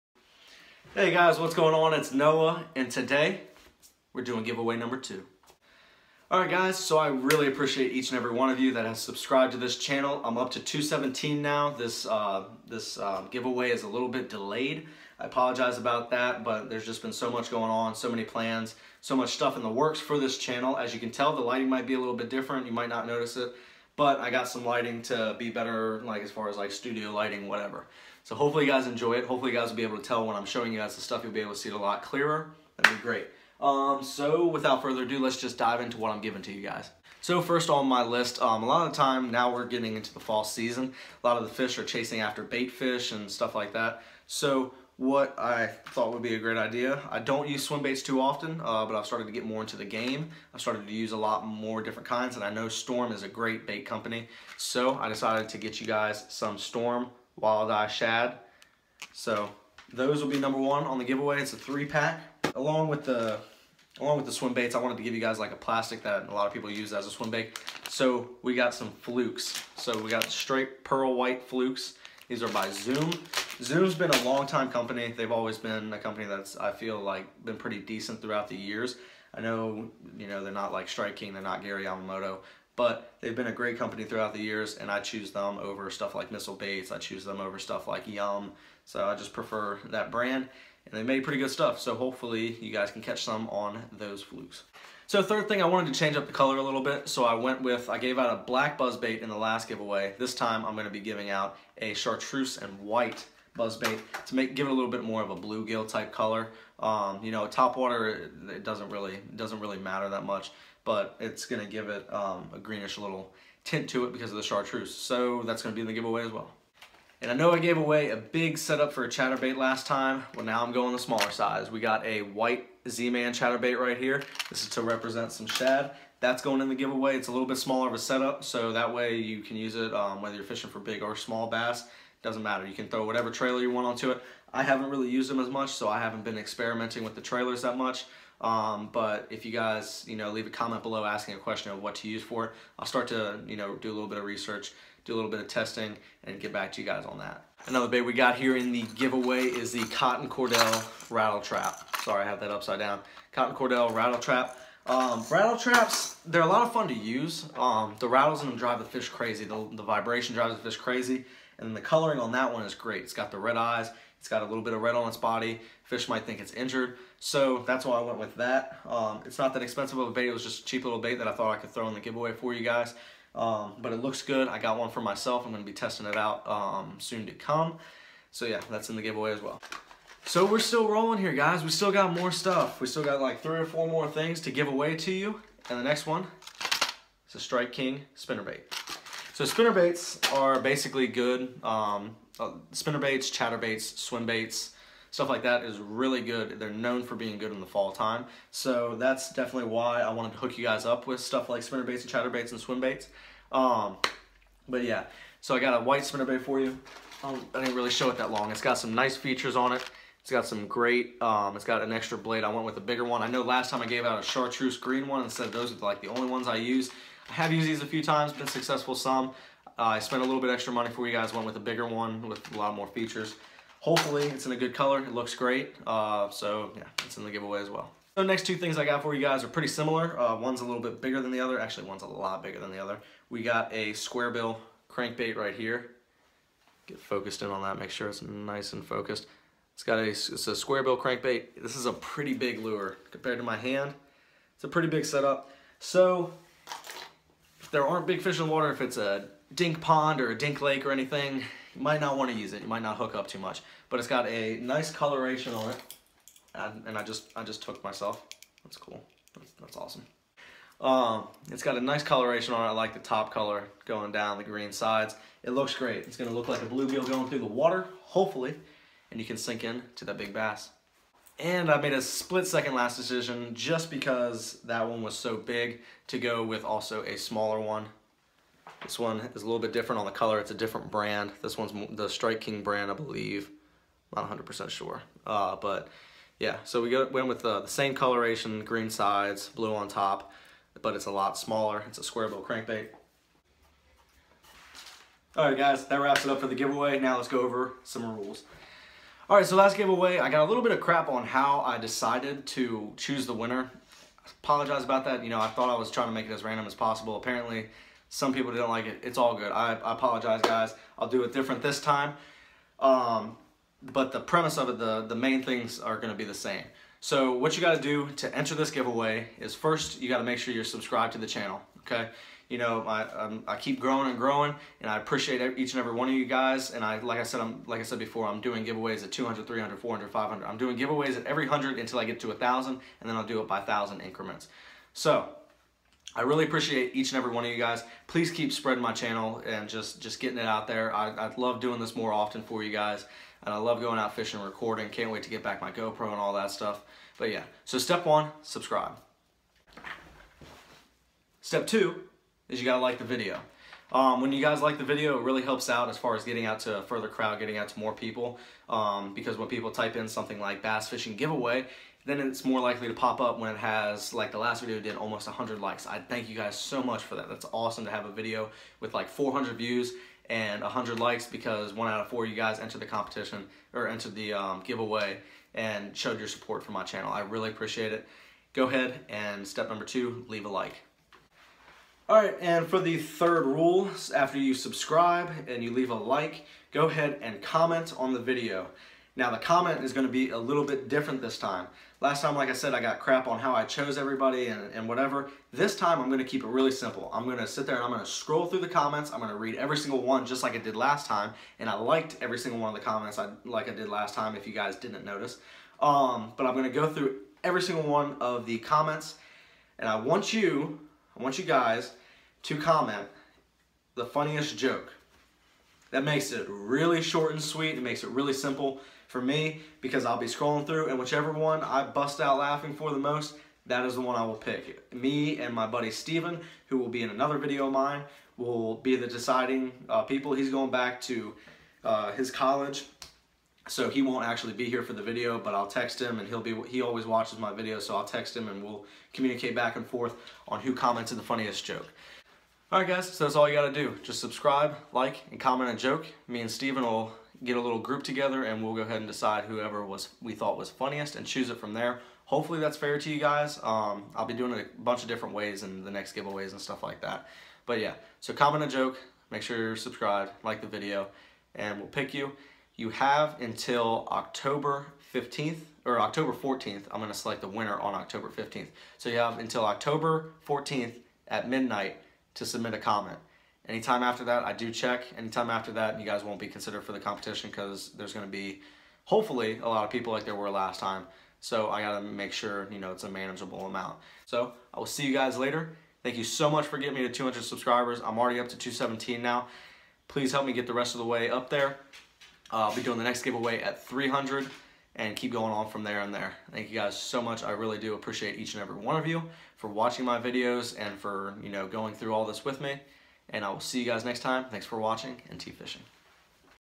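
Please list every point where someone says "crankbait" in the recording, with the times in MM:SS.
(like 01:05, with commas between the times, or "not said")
03:54, 04:00, 04:52.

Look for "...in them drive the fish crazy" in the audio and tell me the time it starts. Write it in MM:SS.
02:38.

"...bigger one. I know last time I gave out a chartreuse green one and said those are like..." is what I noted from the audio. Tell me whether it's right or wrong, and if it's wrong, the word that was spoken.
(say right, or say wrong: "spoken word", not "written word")
right.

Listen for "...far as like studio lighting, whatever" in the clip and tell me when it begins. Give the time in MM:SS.
00:26.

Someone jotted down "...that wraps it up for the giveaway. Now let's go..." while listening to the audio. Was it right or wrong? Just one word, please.
right.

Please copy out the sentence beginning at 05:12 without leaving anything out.
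Um, but the premise of it, the, the main things are gonna be the same.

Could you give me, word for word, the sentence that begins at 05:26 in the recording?
And I, like I said, I'm like I said before, I'm doing giveaways at 200, 300, 400, 500.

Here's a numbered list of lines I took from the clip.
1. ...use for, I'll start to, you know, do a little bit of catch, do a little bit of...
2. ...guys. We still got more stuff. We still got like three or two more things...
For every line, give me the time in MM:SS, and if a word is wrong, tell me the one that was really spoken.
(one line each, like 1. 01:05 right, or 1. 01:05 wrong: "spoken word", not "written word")
1. 02:22 wrong: "research", not "catch"
2. 03:01 wrong: "four", not "two".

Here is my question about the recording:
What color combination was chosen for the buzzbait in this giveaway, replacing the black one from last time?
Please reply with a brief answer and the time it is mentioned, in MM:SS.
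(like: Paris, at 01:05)
Chartreuse and white, at 01:41.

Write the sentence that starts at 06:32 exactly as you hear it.
Last time, like I said, I got crap on how I chose everybody and, and whatever.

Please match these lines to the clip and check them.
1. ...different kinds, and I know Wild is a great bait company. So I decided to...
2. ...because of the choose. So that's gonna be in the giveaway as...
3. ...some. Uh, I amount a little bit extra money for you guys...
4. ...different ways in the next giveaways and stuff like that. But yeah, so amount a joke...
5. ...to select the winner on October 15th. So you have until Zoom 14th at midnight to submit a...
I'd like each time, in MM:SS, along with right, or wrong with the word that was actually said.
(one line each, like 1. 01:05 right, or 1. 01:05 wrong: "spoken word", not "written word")
1. 00:51 wrong: "Storm", not "Wild"
2. 01:54 wrong: "chartreuse", not "choose"
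3. 03:38 wrong: "spent", not "amount"
4. 07:35 wrong: "comment", not "amount"
5. 07:47 wrong: "October", not "Zoom".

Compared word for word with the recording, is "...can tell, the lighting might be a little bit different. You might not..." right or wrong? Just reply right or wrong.
right.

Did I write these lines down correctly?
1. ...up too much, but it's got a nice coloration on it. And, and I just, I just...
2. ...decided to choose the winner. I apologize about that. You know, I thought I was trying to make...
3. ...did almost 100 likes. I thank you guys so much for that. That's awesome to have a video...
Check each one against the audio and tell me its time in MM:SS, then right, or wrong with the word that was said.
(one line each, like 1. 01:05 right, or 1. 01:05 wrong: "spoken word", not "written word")
1. 04:13 right
2. 05:01 right
3. 06:04 right.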